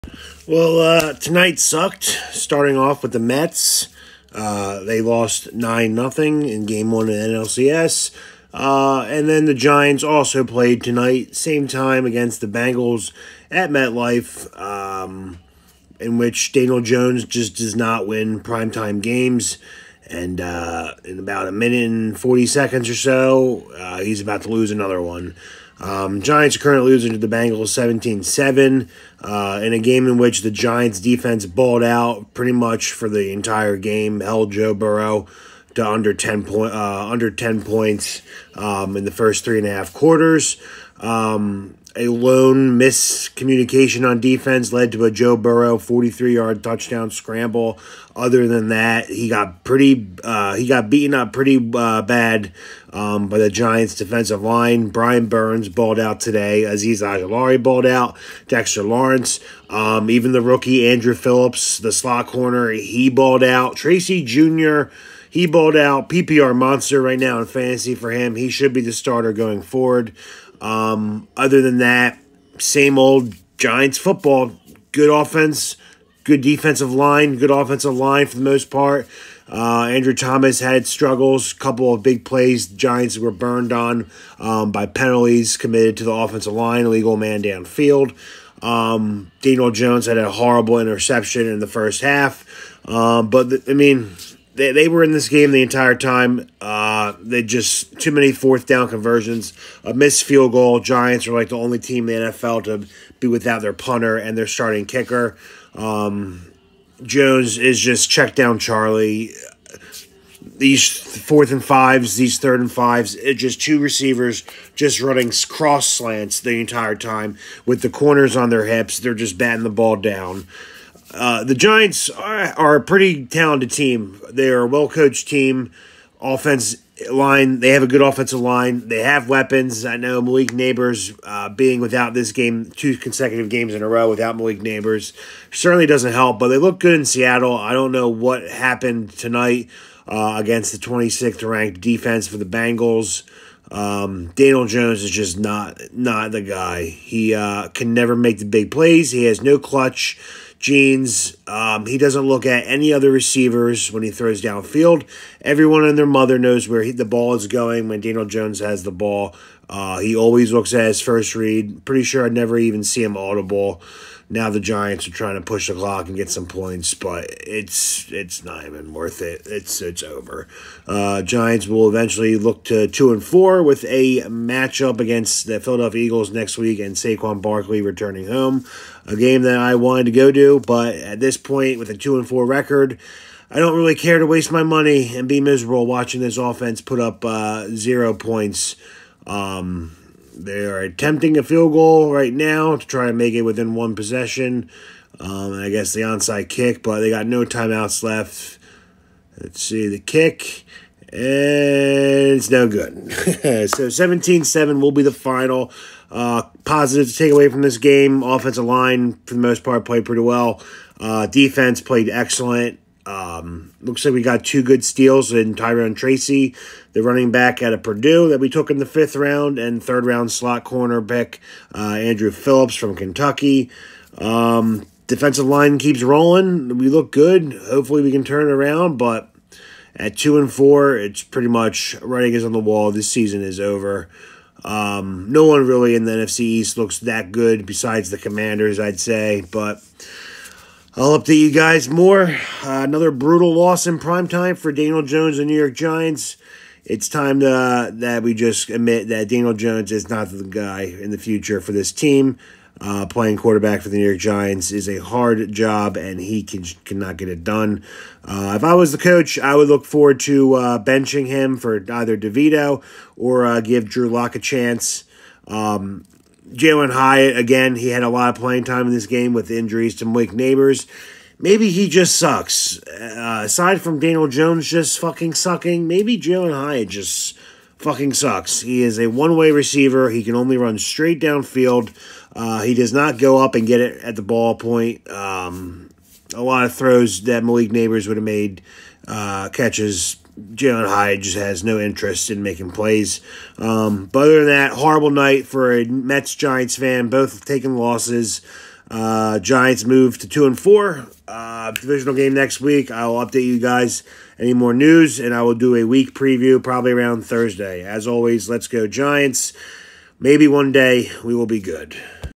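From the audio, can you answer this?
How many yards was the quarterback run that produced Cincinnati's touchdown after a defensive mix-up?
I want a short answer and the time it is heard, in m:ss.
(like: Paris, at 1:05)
43, at 0:45.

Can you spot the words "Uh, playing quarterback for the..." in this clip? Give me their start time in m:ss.
4:12.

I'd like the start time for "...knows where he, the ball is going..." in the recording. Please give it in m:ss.
2:36.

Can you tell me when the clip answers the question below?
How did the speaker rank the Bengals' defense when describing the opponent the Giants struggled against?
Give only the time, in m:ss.
2:20.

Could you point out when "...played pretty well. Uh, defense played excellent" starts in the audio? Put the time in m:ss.
3:29.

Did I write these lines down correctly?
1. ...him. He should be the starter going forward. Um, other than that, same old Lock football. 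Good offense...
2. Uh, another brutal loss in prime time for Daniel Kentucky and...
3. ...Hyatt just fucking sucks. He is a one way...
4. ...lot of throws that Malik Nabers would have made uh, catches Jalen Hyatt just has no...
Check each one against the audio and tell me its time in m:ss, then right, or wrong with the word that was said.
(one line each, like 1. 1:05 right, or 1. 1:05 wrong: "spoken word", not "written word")
1. 1:08 wrong: "Giants", not "Lock"
2. 4:02 wrong: "Jones", not "Kentucky"
3. 4:36 right
4. 4:46 right.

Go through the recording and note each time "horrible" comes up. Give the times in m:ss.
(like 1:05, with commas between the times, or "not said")
1:30, 4:54.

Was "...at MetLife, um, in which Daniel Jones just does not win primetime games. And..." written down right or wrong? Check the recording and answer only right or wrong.
right.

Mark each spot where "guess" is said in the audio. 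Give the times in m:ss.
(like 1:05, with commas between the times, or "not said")
3:15.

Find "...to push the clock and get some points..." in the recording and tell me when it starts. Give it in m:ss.
2:45.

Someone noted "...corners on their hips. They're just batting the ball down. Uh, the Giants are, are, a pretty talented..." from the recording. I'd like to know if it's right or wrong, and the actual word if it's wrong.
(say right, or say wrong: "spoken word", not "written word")
right.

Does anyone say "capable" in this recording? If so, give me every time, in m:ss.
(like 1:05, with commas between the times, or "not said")
not said.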